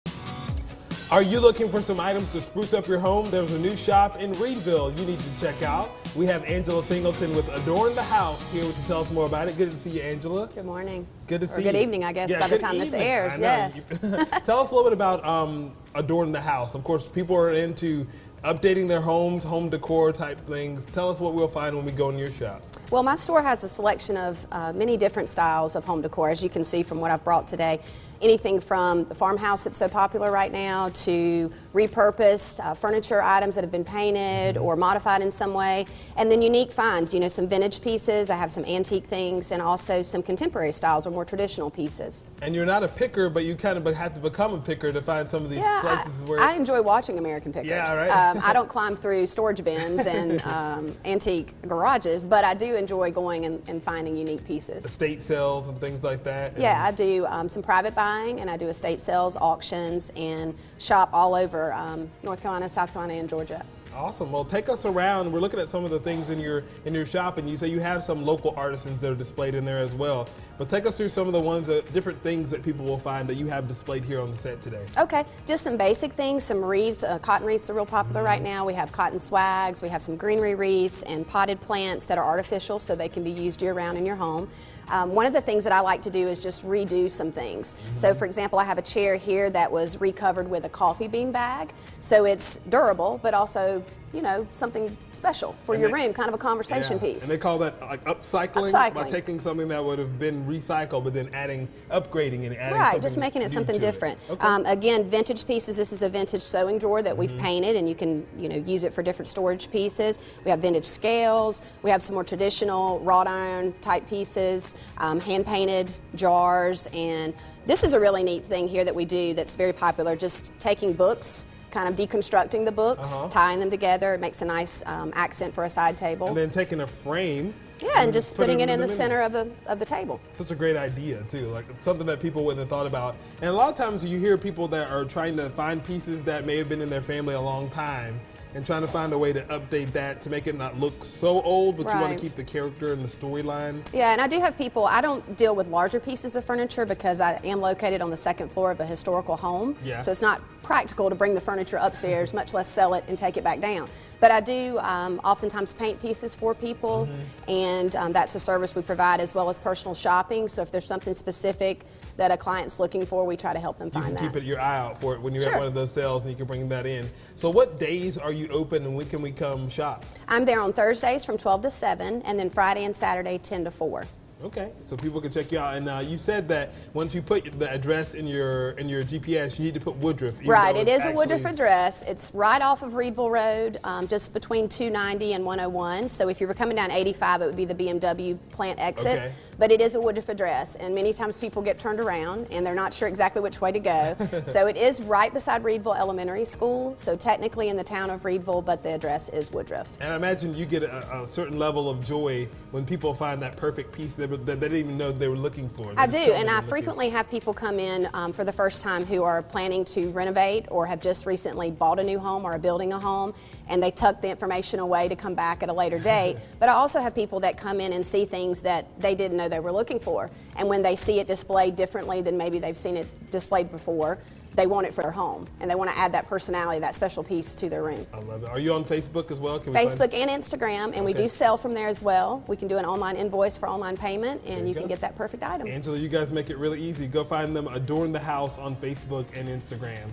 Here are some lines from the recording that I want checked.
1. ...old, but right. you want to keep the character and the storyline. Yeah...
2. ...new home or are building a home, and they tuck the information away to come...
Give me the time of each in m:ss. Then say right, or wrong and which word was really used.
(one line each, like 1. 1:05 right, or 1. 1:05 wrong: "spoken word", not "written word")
1. 2:21 right
2. 3:32 right.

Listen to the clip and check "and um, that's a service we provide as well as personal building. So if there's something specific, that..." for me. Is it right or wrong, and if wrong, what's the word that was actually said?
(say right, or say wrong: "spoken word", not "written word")
wrong: "shopping", not "building".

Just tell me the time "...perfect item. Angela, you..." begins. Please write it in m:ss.
3:55.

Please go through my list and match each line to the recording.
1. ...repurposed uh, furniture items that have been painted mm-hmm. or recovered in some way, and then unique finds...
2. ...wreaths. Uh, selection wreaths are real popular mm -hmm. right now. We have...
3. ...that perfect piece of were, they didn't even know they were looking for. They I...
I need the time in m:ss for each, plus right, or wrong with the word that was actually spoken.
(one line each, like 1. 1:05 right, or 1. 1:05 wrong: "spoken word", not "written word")
1. 0:31 wrong: "modified", not "recovered"
2. 1:16 wrong: "cotton", not "selection"
3. 3:23 right.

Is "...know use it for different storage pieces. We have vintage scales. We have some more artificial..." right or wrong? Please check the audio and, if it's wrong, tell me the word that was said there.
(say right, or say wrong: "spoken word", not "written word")
wrong: "traditional", not "artificial".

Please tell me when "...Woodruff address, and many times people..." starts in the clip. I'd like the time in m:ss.
3:10.